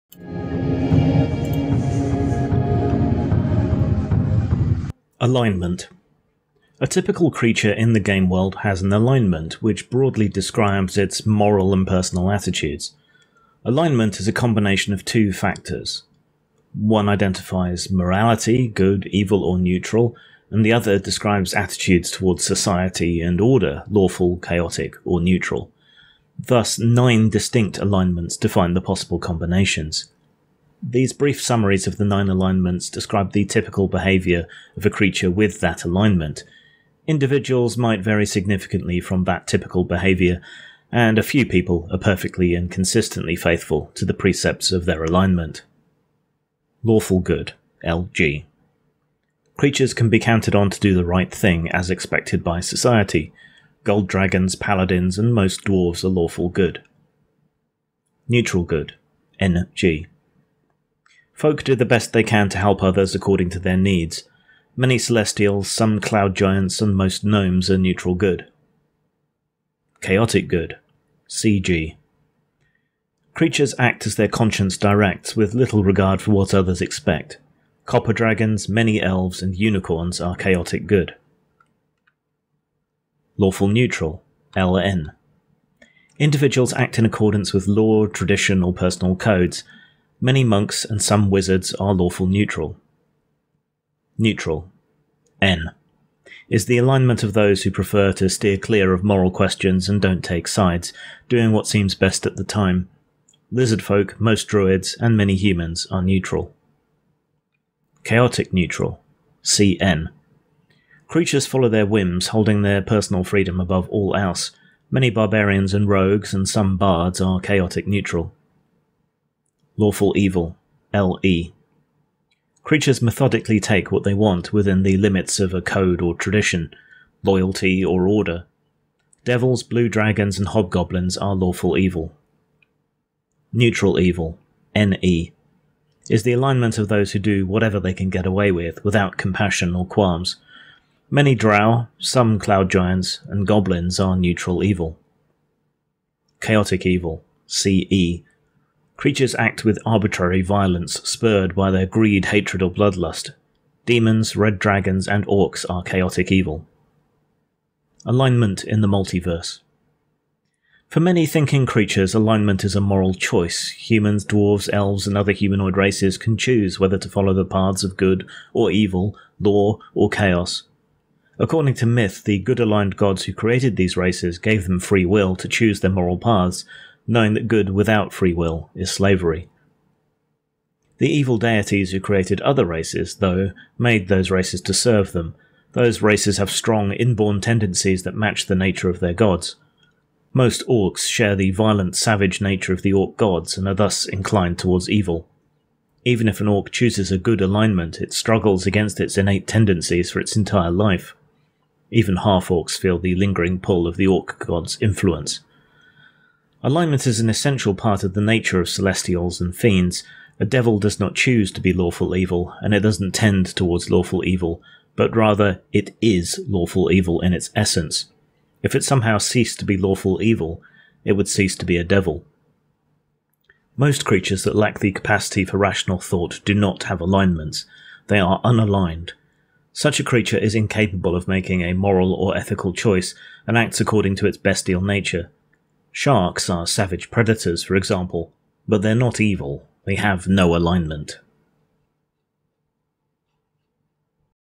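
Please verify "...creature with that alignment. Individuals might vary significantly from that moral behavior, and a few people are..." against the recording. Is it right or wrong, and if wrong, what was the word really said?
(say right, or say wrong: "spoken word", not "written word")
wrong: "typical", not "moral".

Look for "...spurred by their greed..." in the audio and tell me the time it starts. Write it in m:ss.
2:31.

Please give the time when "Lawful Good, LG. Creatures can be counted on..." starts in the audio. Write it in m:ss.
0:46.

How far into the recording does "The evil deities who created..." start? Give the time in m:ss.
3:00.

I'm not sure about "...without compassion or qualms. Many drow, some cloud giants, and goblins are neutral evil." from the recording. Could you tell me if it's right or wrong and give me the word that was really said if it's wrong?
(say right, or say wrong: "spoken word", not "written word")
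right.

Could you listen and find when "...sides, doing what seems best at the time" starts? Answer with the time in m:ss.
1:40.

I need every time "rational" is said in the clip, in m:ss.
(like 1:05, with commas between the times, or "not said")
3:45.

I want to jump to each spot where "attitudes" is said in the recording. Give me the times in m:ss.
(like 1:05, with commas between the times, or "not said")
0:12, 0:21.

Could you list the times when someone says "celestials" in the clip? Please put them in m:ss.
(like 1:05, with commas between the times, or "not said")
1:04, 3:28.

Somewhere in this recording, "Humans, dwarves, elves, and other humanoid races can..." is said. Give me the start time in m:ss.
2:43.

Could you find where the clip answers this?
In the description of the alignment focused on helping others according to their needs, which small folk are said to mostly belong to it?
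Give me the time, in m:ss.
1:06.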